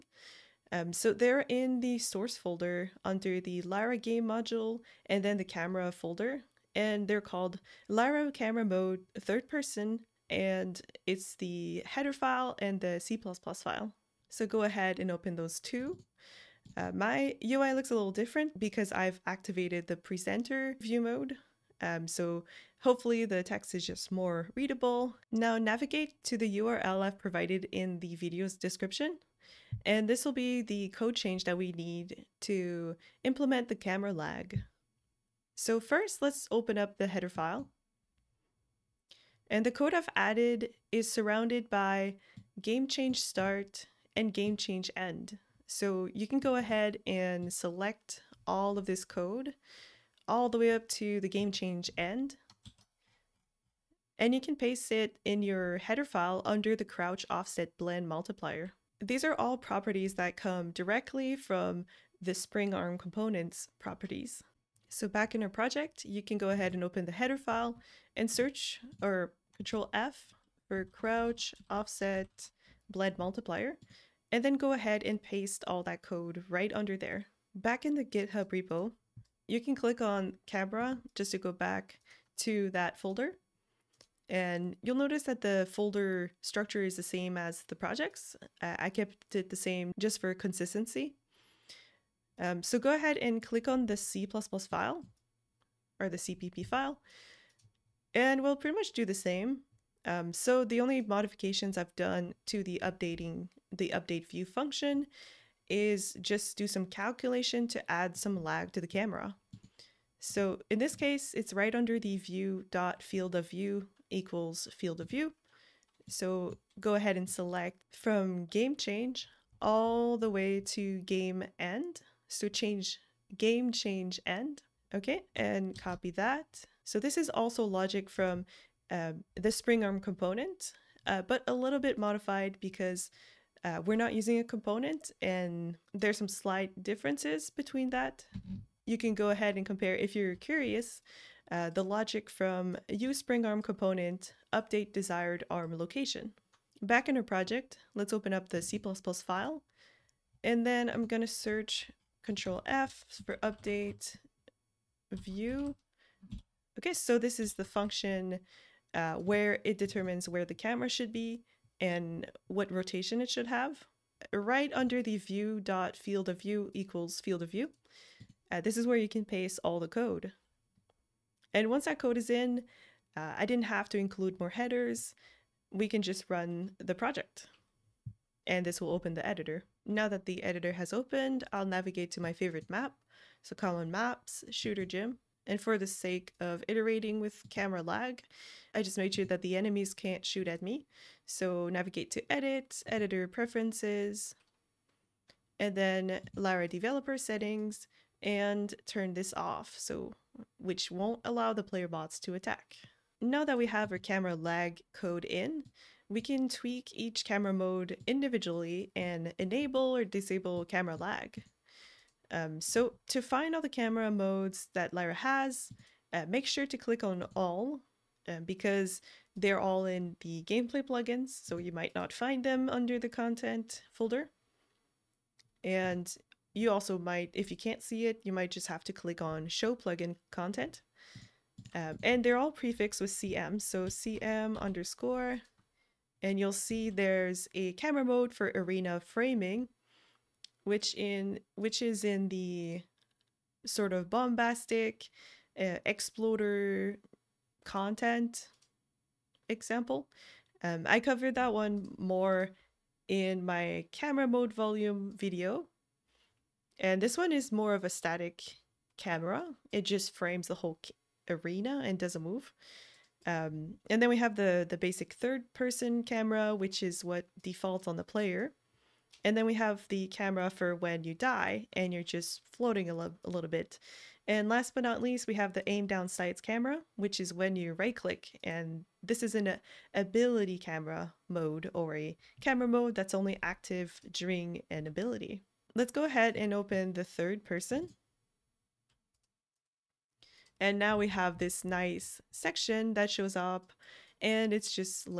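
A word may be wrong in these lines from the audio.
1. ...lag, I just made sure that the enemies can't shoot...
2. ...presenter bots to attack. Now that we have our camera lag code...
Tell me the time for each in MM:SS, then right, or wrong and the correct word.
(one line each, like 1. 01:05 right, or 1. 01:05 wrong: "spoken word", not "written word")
1. 03:07 right
2. 03:21 wrong: "player", not "presenter".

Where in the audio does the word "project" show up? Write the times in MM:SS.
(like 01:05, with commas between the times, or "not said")
01:05, 01:27, 02:27, 02:56.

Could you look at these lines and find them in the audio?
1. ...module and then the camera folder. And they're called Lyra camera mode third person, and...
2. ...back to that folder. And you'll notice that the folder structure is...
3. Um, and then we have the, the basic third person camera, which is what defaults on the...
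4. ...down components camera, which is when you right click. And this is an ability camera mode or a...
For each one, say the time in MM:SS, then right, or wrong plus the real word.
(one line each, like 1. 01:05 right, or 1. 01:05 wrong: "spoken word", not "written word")
1. 00:04 right
2. 01:21 right
3. 04:23 right
4. 04:35 wrong: "sights", not "components".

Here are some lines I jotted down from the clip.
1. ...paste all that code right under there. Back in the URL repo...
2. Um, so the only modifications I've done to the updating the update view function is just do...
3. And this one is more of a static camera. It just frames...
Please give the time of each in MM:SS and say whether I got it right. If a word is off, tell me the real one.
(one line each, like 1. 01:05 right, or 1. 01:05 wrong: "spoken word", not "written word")
1. 01:15 wrong: "GitHub", not "URL"
2. 01:40 right
3. 04:16 right.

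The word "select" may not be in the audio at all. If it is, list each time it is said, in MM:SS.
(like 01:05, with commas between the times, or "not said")
00:47, 01:57.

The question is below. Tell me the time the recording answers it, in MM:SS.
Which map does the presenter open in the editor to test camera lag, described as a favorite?
03:04.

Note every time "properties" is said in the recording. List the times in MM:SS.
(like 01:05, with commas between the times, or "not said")
00:59, 01:03.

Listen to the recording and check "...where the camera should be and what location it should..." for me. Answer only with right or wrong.
wrong.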